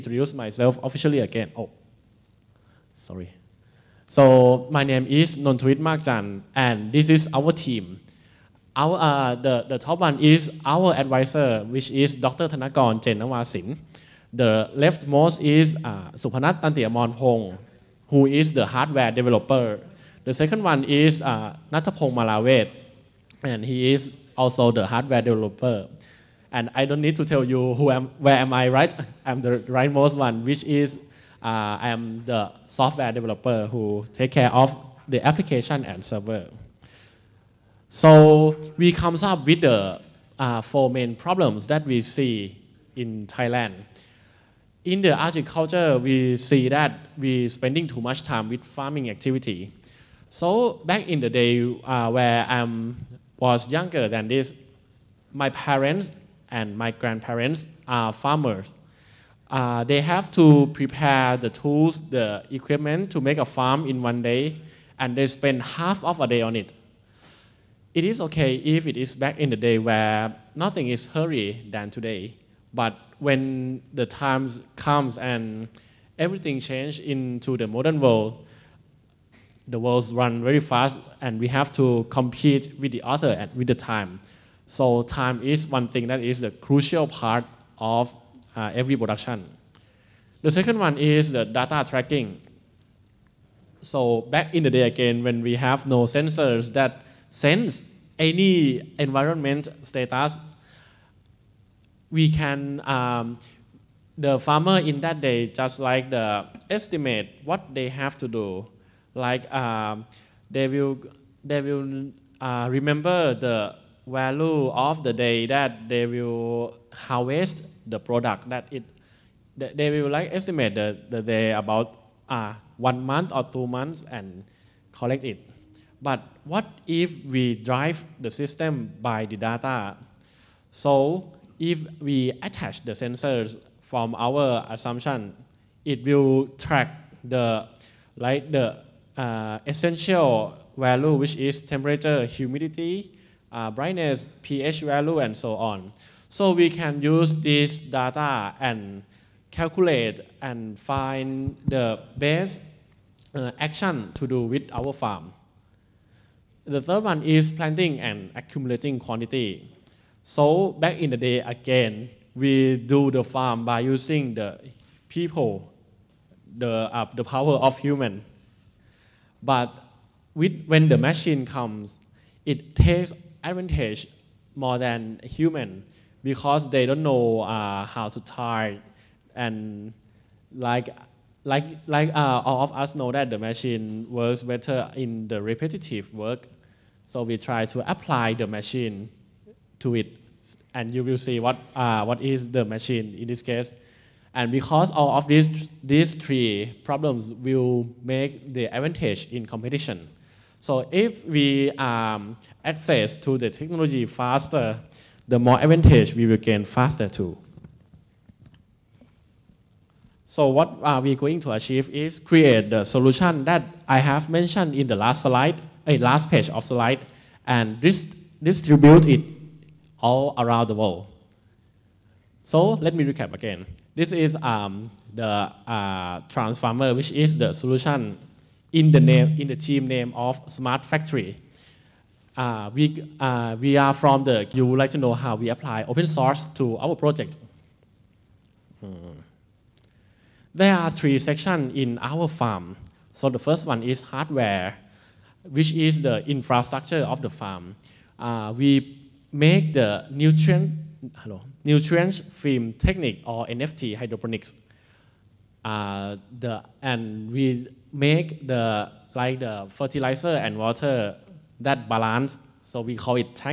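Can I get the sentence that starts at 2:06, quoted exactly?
But what if we drive the system by the data?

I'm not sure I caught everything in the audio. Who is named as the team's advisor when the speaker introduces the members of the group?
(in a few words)
Dr. Thanakorn Jennawasin.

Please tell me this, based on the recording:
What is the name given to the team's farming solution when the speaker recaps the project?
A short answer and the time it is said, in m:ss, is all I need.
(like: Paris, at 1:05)
Transfarmer, at 3:46.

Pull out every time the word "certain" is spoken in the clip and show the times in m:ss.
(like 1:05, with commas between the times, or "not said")
not said.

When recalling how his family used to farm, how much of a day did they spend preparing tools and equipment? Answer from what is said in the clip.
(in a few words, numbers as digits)
half of a day.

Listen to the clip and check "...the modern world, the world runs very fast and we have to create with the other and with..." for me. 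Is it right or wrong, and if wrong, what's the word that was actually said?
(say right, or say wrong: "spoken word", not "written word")
wrong: "compete", not "create".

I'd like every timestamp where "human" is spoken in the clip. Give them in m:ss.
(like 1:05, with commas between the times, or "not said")
2:47, 2:55.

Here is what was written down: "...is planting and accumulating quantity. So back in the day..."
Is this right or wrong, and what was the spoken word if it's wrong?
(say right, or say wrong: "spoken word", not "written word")
right.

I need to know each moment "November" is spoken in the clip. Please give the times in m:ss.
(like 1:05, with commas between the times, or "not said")
not said.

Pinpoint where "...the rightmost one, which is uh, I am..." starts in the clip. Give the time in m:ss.
0:29.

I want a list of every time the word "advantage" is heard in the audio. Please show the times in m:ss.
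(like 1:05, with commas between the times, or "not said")
2:53, 3:18, 3:25.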